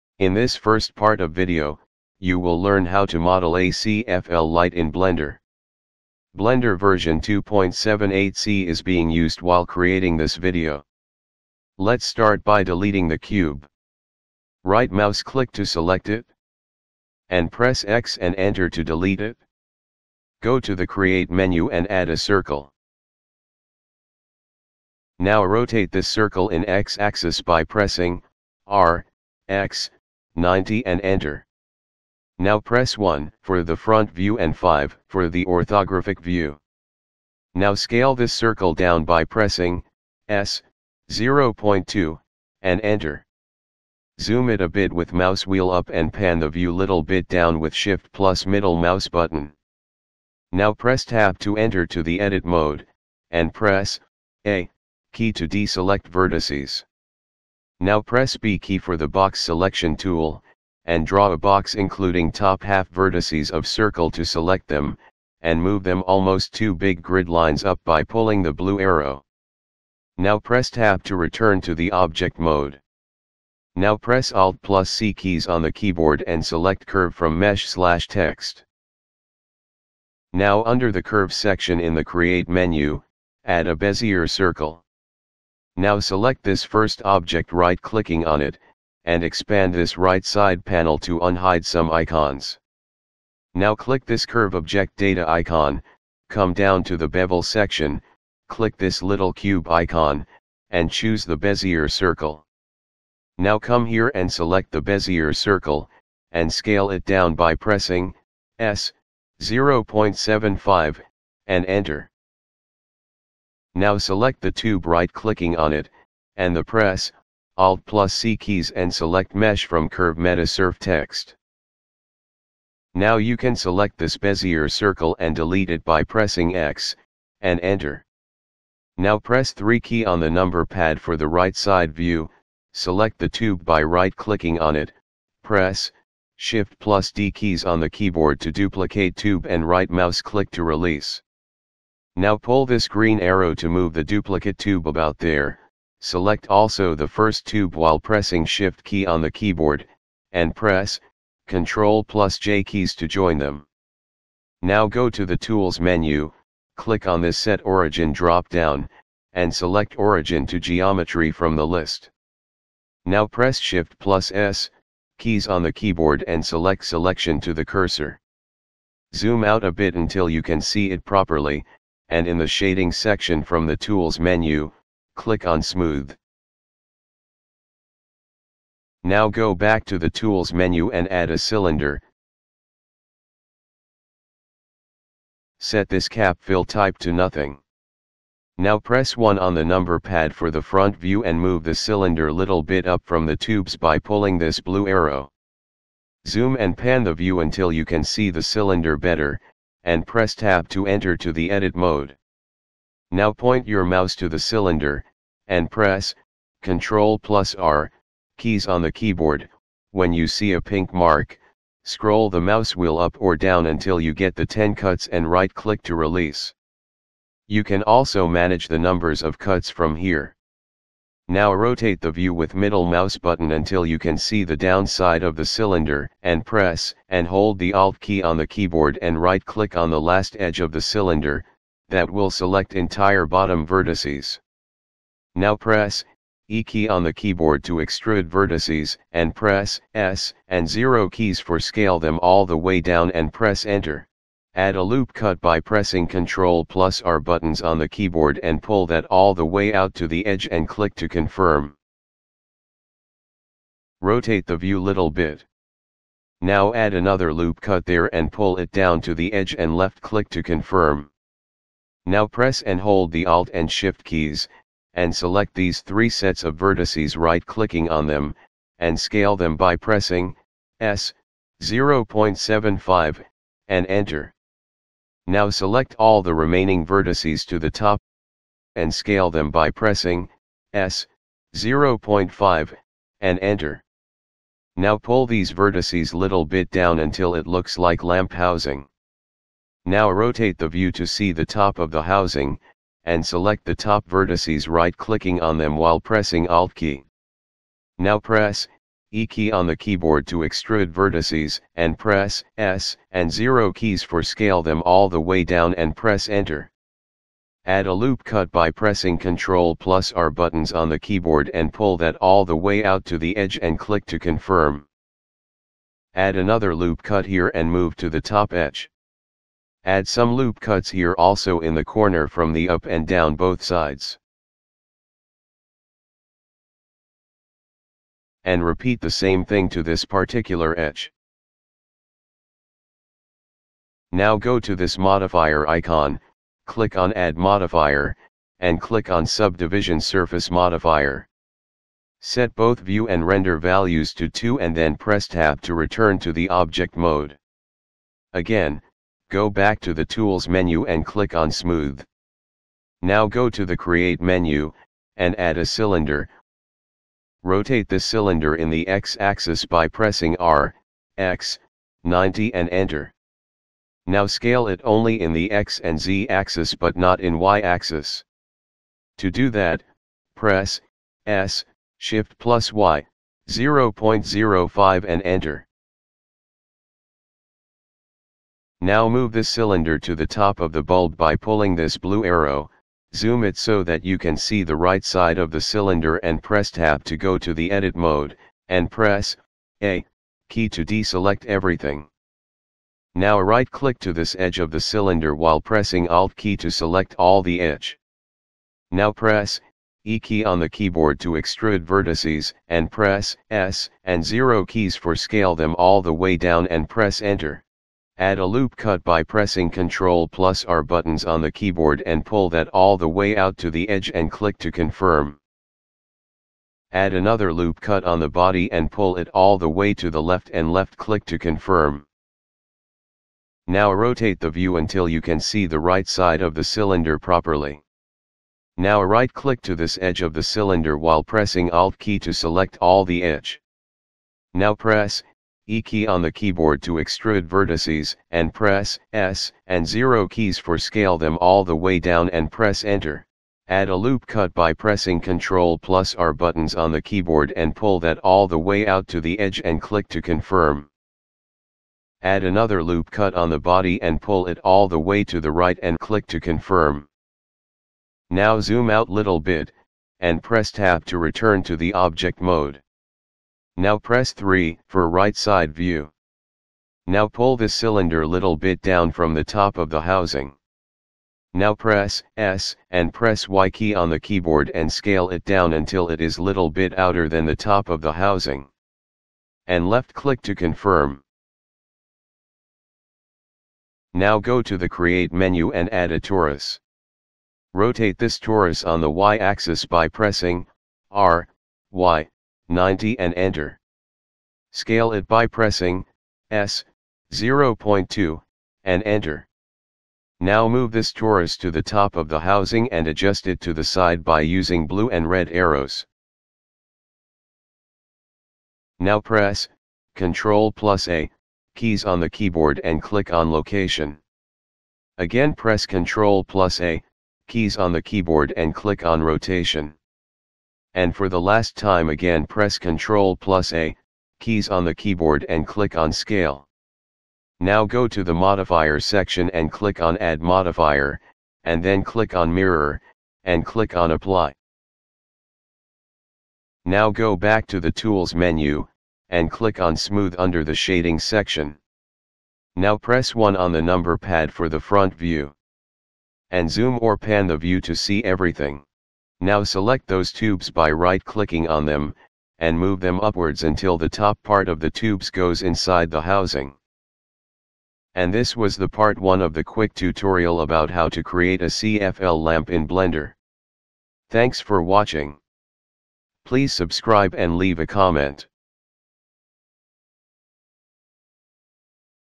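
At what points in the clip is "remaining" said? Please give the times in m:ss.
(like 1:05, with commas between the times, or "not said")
4:36.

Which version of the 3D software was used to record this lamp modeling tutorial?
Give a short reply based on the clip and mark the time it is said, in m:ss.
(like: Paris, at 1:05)
2.78c, at 0:07.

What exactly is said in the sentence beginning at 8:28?
Now press, Ctrl plus A, keys on the keyboard and click on location.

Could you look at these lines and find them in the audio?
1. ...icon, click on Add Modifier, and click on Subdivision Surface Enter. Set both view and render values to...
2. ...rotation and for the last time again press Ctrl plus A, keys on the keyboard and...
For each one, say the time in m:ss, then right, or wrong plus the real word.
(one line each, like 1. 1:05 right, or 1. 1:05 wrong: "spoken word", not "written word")
1. 5:35 wrong: "Modifier", not "Enter"
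2. 8:39 right.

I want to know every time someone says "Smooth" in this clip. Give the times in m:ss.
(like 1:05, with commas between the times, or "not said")
2:55, 5:51, 8:59.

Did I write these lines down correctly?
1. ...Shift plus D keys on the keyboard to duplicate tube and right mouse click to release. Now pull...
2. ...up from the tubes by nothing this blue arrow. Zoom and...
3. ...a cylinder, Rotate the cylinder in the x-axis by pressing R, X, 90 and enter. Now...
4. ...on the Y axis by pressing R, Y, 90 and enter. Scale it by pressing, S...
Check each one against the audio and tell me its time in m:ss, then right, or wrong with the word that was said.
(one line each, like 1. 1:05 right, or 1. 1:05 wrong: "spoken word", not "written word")
1. 2:16 right
2. 3:12 wrong: "pulling", not "nothing"
3. 5:55 right
4. 8:08 right.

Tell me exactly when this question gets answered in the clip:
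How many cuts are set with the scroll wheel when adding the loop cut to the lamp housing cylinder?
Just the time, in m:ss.
3:34.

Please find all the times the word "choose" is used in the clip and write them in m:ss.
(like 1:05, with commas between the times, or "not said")
1:40.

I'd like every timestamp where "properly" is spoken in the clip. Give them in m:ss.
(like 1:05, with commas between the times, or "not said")
2:51, 7:07.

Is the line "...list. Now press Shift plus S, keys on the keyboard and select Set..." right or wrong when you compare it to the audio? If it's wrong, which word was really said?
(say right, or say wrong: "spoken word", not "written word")
wrong: "Selection", not "Set".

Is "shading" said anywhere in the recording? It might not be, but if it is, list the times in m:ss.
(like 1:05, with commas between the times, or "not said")
2:52, 9:00.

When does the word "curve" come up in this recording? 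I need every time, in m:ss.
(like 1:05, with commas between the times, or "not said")
1:16, 1:21, 1:34, 1:59.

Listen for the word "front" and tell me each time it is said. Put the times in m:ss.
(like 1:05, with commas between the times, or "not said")
0:33, 3:10, 9:04.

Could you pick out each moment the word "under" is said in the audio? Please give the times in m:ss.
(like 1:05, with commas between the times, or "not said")
1:20, 9:00.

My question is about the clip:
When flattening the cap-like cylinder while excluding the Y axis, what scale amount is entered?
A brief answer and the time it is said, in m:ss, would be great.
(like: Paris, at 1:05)
0.05, at 6:13.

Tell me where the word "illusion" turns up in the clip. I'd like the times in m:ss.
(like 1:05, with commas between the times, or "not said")
not said.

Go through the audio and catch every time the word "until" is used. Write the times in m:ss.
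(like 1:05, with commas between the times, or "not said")
2:49, 3:17, 3:33, 3:43, 4:46, 7:04, 7:55, 9:13.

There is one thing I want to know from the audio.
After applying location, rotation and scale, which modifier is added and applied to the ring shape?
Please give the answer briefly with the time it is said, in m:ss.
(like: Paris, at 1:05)
Mirror, at 8:52.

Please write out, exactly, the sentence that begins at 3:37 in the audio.
You can also manage the numbers of cuts from here.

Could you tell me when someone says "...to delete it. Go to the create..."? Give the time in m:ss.
0:18.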